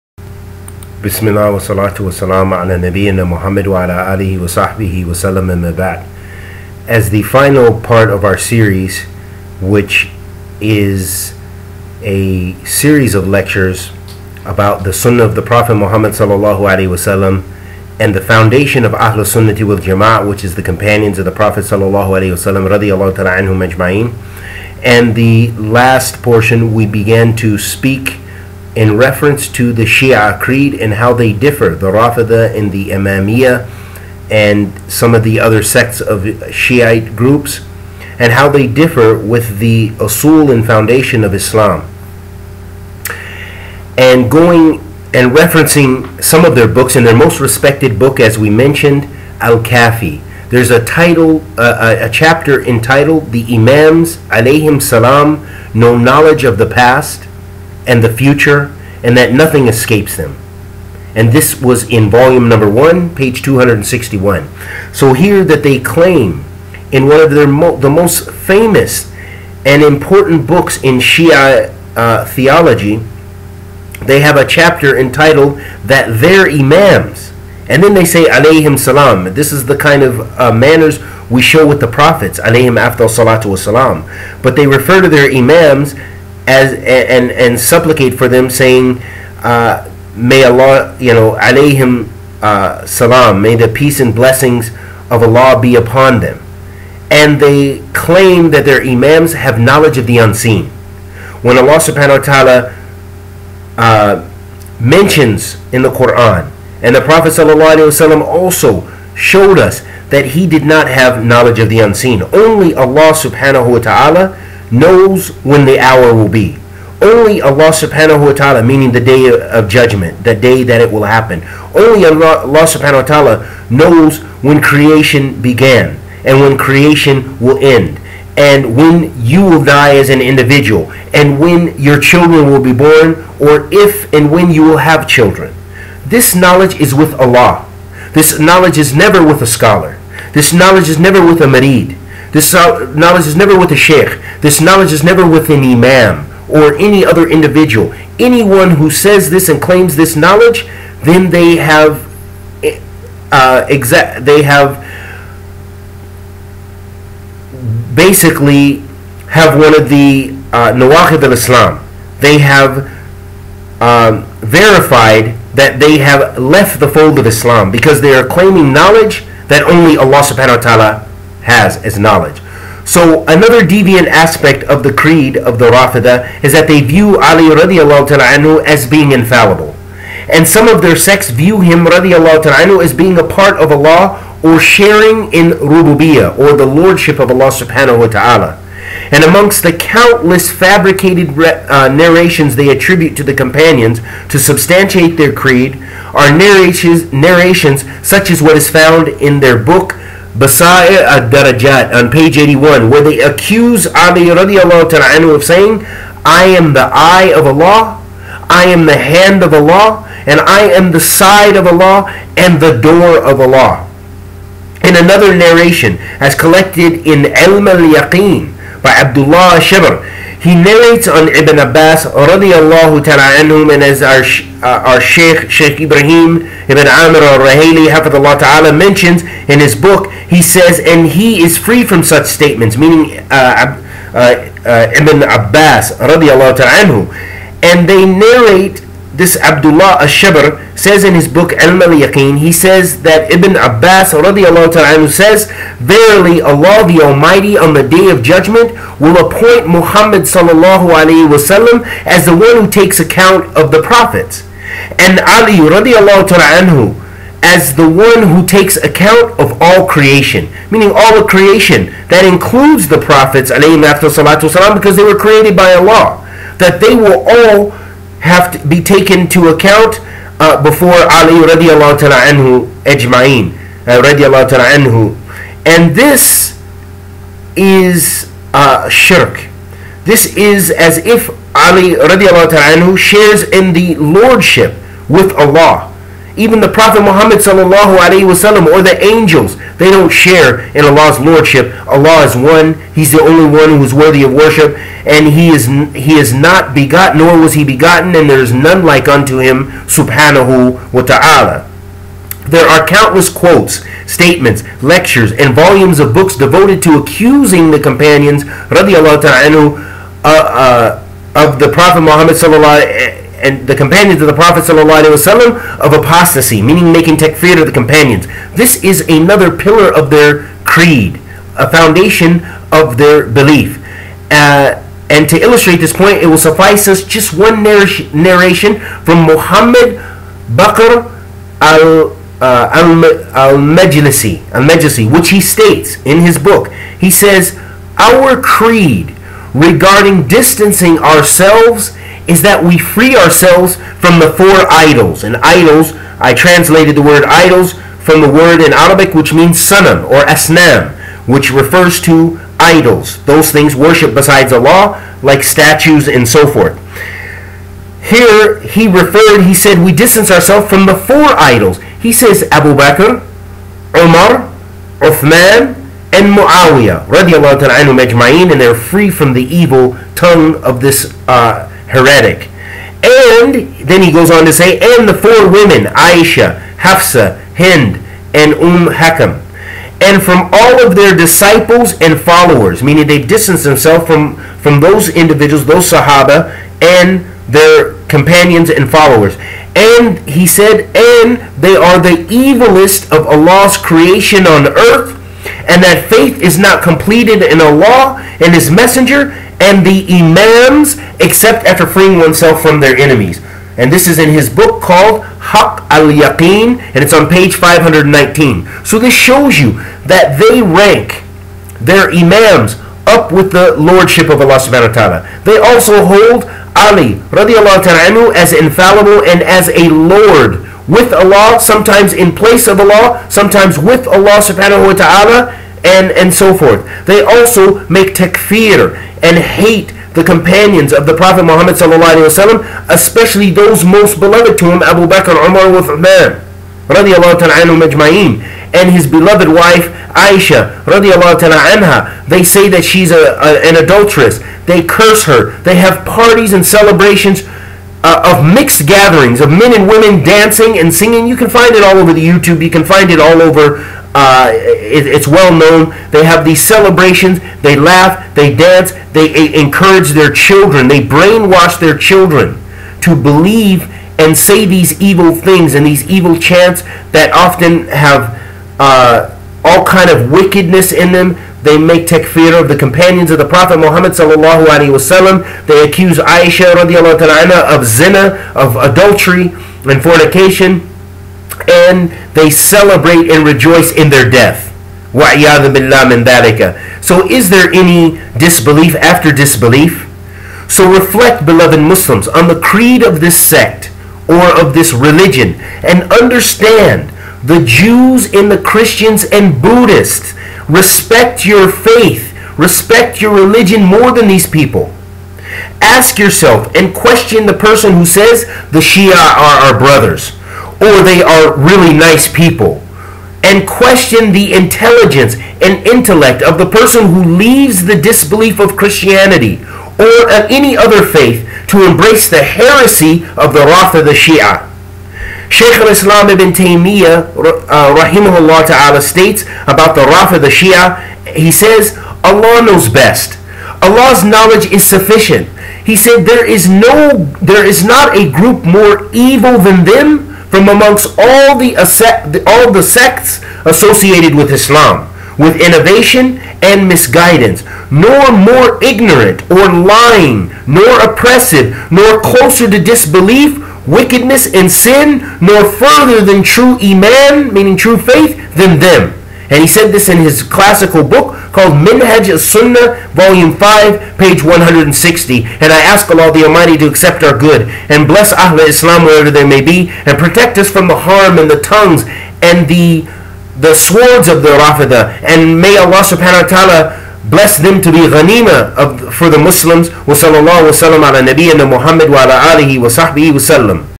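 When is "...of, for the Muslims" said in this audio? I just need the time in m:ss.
9:38.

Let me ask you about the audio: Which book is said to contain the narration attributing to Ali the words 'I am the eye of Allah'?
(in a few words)
Basa'ir al-Darajat.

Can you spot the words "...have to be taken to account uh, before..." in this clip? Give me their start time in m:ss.
4:28.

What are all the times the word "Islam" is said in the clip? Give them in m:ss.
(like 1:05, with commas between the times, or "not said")
0:41, 2:41, 2:47, 8:45, 9:04, 9:28.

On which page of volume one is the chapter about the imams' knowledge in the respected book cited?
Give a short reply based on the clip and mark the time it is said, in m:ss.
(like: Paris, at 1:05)
261, at 1:03.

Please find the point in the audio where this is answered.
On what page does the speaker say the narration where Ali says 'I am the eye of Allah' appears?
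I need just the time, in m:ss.
3:22.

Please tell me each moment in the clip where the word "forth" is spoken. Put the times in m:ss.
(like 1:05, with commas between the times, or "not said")
5:56, 7:06.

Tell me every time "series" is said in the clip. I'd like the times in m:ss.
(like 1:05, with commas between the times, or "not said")
0:08, 0:12.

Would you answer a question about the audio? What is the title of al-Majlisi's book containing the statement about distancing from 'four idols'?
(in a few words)
Haq al Yaqeen.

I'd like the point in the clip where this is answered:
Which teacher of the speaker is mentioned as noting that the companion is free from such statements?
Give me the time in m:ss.
3:45.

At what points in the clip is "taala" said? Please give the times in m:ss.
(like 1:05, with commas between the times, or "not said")
1:42, 1:53, 5:01.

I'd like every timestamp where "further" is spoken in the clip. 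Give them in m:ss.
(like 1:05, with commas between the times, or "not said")
9:15.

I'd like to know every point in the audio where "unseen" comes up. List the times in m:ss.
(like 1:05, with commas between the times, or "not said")
1:40, 1:51.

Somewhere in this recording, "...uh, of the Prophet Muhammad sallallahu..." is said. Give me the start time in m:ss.
5:10.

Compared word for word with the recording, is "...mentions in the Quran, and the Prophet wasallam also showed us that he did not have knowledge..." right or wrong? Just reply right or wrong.
right.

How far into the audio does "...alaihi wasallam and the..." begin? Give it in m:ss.
0:16.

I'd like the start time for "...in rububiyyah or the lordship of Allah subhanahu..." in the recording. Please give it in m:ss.
3:05.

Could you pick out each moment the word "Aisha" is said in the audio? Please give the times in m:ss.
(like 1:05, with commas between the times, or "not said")
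6:15, 7:20, 7:56.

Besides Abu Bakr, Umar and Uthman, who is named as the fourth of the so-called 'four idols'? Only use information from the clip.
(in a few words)
Muawiyah.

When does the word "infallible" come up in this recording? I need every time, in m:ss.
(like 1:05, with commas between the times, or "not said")
2:59, 6:58.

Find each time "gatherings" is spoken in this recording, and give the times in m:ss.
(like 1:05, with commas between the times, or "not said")
7:28.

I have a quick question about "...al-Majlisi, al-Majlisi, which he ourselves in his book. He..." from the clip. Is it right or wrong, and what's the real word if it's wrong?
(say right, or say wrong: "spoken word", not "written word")
wrong: "states", not "ourselves".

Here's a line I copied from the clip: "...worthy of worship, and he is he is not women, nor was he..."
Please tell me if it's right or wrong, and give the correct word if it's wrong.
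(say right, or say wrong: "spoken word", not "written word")
wrong: "begotten", not "women".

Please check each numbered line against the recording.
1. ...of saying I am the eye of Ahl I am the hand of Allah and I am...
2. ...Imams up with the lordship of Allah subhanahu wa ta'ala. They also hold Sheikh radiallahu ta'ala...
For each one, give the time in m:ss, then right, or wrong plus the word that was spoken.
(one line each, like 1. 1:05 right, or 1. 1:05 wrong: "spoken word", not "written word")
1. 3:25 wrong: "Allah", not "Ahl"
2. 6:52 wrong: "Ali", not "Sheikh".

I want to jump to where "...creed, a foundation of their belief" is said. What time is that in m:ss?
5:20.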